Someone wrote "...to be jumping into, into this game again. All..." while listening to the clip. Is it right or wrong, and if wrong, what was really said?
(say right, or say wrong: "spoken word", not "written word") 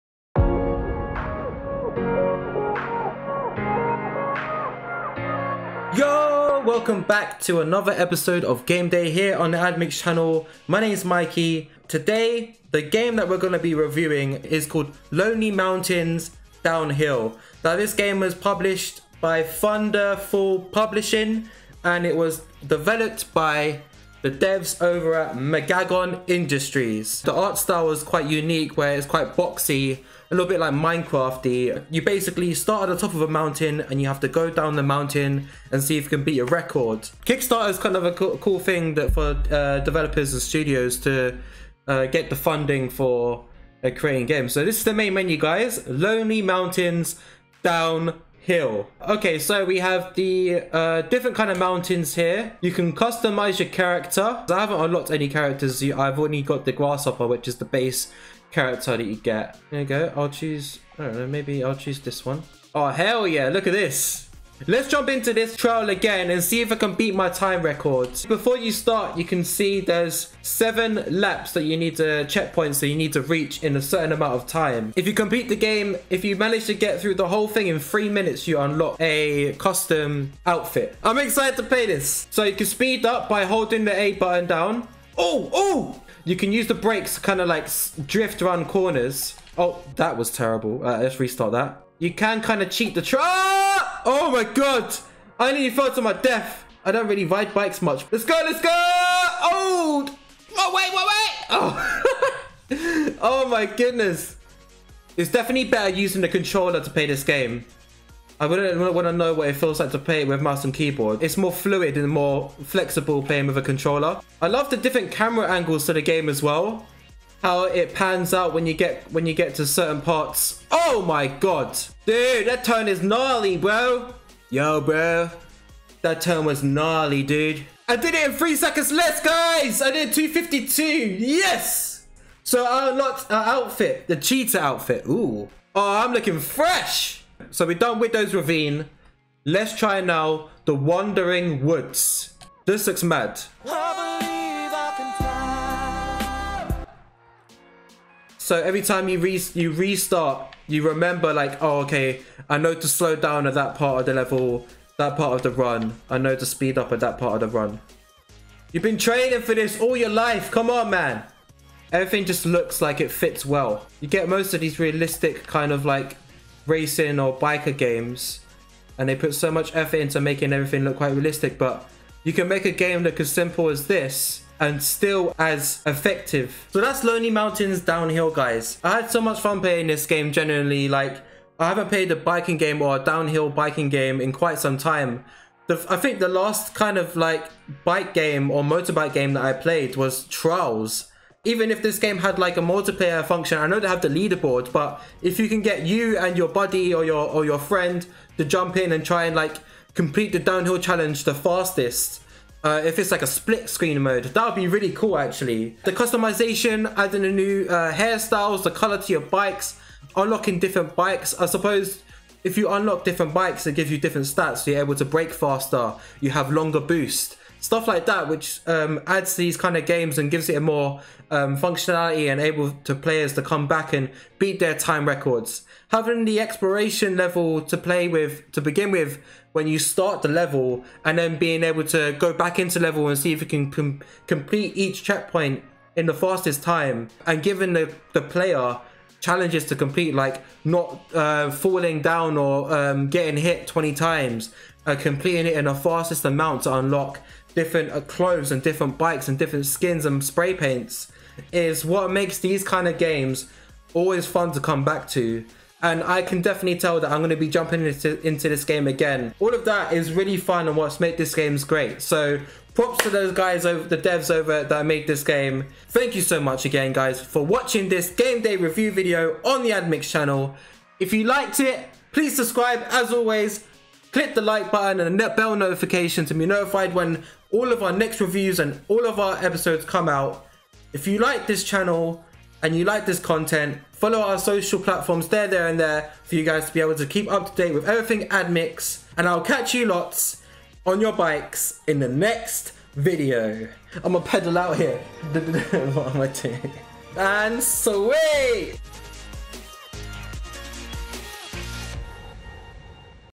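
right.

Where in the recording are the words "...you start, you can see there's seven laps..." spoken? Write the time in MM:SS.
01:08.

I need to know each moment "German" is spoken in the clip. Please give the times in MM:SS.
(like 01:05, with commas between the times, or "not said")
not said.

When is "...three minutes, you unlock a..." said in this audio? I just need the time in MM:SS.
01:17.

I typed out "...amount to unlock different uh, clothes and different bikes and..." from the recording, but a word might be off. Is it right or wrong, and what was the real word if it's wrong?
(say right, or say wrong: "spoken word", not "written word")
right.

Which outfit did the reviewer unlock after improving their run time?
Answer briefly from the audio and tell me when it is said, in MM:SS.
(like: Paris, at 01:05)
the cheetah outfit, at 02:14.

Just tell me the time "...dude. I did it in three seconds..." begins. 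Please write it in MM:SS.
02:07.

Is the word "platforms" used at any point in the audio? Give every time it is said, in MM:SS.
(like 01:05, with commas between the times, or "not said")
04:44.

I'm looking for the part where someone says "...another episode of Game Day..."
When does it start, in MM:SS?
00:07.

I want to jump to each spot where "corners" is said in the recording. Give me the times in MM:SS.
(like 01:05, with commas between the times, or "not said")
01:28.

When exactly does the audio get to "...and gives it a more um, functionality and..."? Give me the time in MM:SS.
03:40.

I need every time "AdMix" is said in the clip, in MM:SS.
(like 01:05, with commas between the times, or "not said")
00:09, 04:29, 04:48.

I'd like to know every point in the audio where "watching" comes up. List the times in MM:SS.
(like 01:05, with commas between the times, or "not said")
04:27.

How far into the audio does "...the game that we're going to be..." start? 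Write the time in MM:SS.
00:12.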